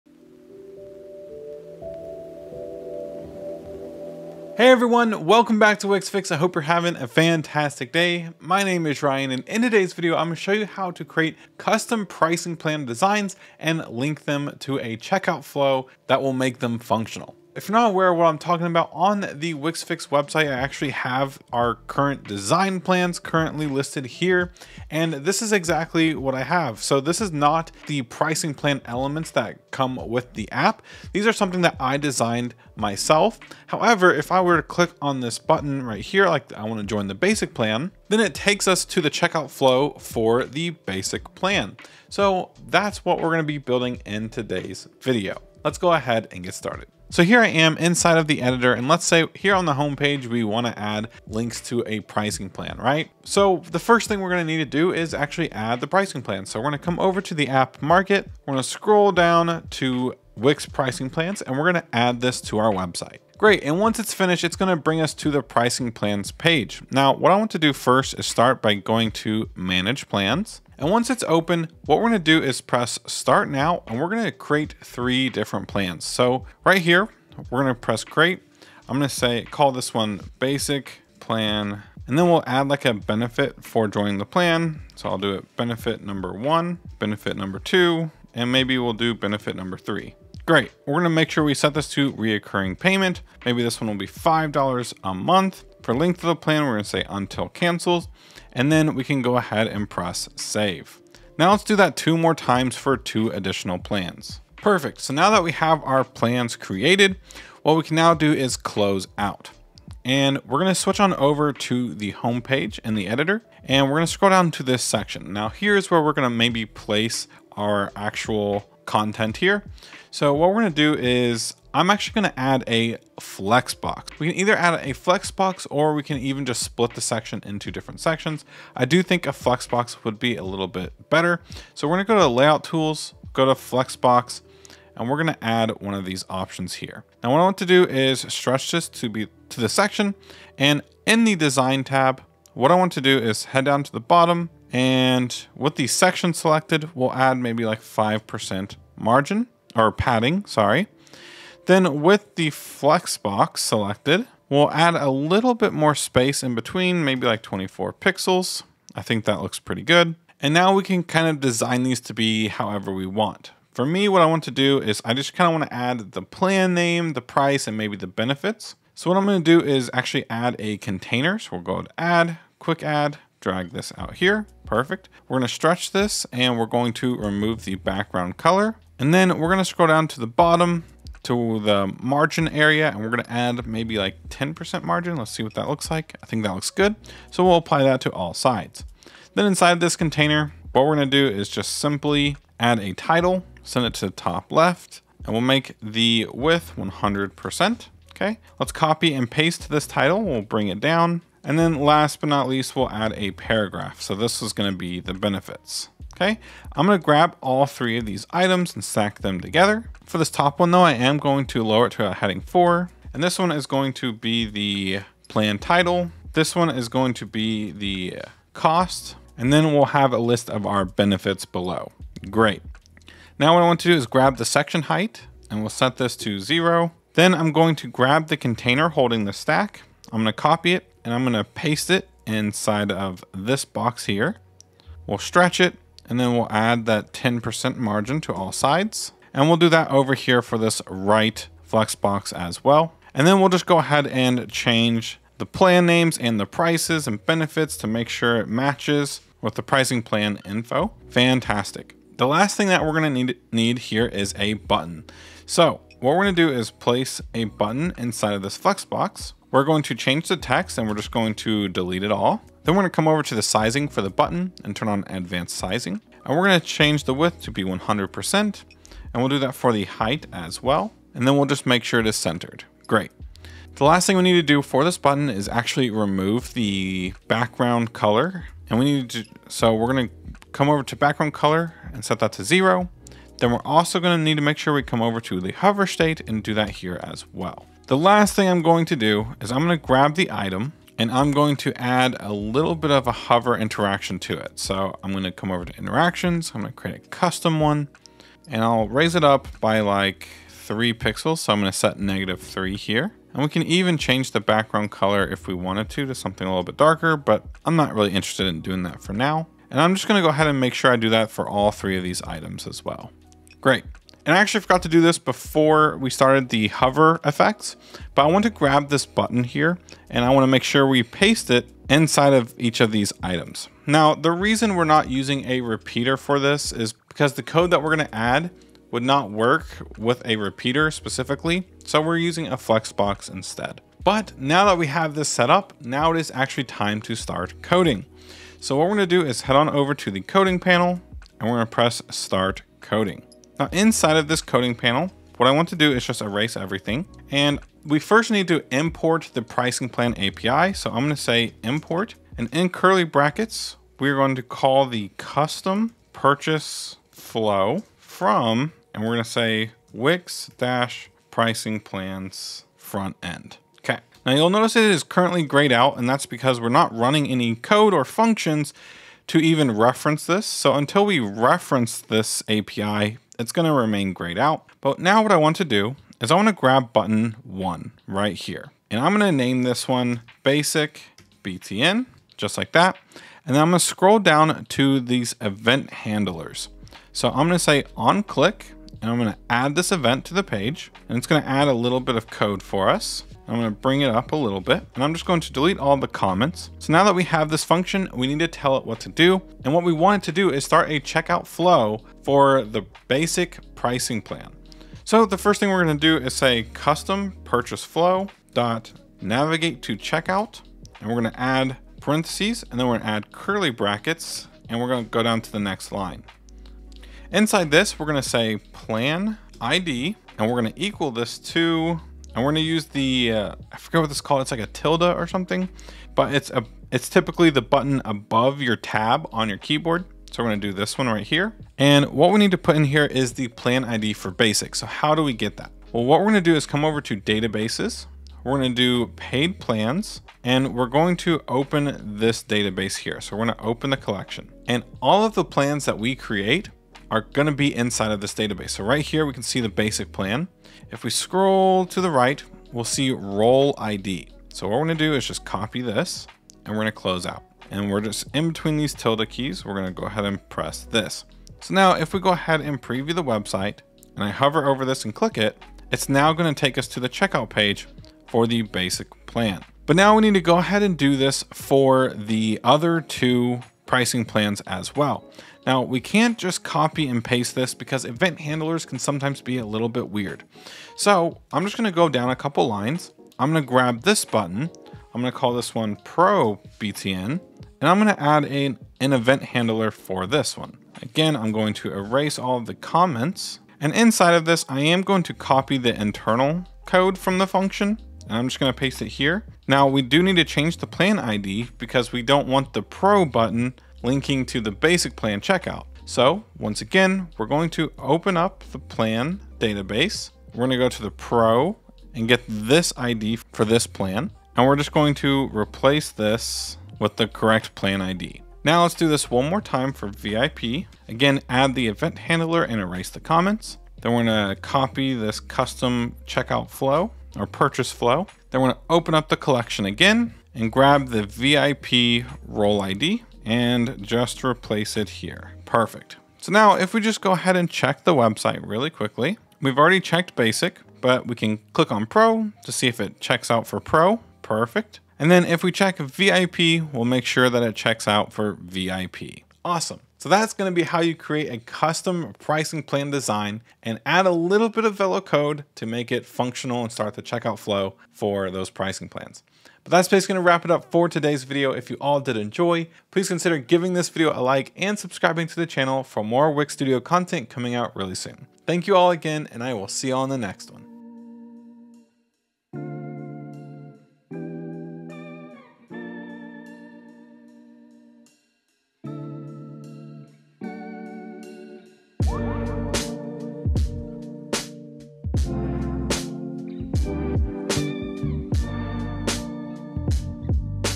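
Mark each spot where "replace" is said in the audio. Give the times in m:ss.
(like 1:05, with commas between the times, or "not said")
8:35, 8:54.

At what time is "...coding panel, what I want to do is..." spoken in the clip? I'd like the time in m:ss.
5:44.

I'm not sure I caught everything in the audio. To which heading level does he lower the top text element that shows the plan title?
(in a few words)
heading four.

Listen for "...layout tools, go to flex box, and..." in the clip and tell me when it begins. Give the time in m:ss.
2:12.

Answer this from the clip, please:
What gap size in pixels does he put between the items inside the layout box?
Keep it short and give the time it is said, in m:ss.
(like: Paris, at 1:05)
24 pixels, at 2:37.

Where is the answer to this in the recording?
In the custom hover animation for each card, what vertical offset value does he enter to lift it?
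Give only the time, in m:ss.
5:01.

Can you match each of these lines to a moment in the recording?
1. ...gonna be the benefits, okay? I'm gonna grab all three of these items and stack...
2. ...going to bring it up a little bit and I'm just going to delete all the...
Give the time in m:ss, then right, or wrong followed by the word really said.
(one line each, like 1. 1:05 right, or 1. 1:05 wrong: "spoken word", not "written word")
1. 3:24 right
2. 6:33 right.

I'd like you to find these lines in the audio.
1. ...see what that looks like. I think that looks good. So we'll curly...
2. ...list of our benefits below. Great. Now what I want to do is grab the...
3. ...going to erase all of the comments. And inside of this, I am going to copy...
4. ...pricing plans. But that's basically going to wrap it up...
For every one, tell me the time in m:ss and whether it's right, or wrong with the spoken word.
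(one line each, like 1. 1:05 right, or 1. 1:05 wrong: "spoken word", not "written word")
1. 3:05 wrong: "apply", not "curly"
2. 3:40 right
3. 8:11 right
4. 9:18 right.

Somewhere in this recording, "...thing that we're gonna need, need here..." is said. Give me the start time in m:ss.
4:12.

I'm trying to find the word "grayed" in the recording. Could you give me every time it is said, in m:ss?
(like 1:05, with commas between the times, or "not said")
6:05, 6:14.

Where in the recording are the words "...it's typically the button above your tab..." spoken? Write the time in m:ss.
7:06.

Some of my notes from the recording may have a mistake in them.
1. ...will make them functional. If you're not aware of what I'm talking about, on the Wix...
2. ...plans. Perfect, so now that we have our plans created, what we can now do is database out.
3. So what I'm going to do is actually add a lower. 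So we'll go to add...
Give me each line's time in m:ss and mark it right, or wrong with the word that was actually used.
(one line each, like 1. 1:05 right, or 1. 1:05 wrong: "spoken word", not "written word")
1. 0:16 right
2. 1:43 wrong: "close", not "database"
3. 2:48 wrong: "container", not "lower".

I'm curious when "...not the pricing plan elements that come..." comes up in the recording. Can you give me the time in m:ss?
0:27.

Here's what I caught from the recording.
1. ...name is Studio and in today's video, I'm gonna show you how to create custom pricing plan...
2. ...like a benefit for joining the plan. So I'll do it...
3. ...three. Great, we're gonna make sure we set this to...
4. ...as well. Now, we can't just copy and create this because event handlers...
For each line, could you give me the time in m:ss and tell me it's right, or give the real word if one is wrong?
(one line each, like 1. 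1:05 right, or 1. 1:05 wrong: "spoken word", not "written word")
1. 0:08 wrong: "Ryan", not "Studio"
2. 1:22 right
3. 1:29 right
4. 7:54 wrong: "paste", not "create".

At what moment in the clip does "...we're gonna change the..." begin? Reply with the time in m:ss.
4:26.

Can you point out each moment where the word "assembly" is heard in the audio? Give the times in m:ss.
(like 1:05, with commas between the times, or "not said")
not said.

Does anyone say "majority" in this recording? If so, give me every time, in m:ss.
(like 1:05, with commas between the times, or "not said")
not said.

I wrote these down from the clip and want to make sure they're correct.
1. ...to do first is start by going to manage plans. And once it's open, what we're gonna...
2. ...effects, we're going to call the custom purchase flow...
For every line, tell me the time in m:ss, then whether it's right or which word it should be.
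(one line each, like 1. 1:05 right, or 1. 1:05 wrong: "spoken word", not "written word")
1. 1:07 right
2. 5:53 wrong: "brackets", not "effects".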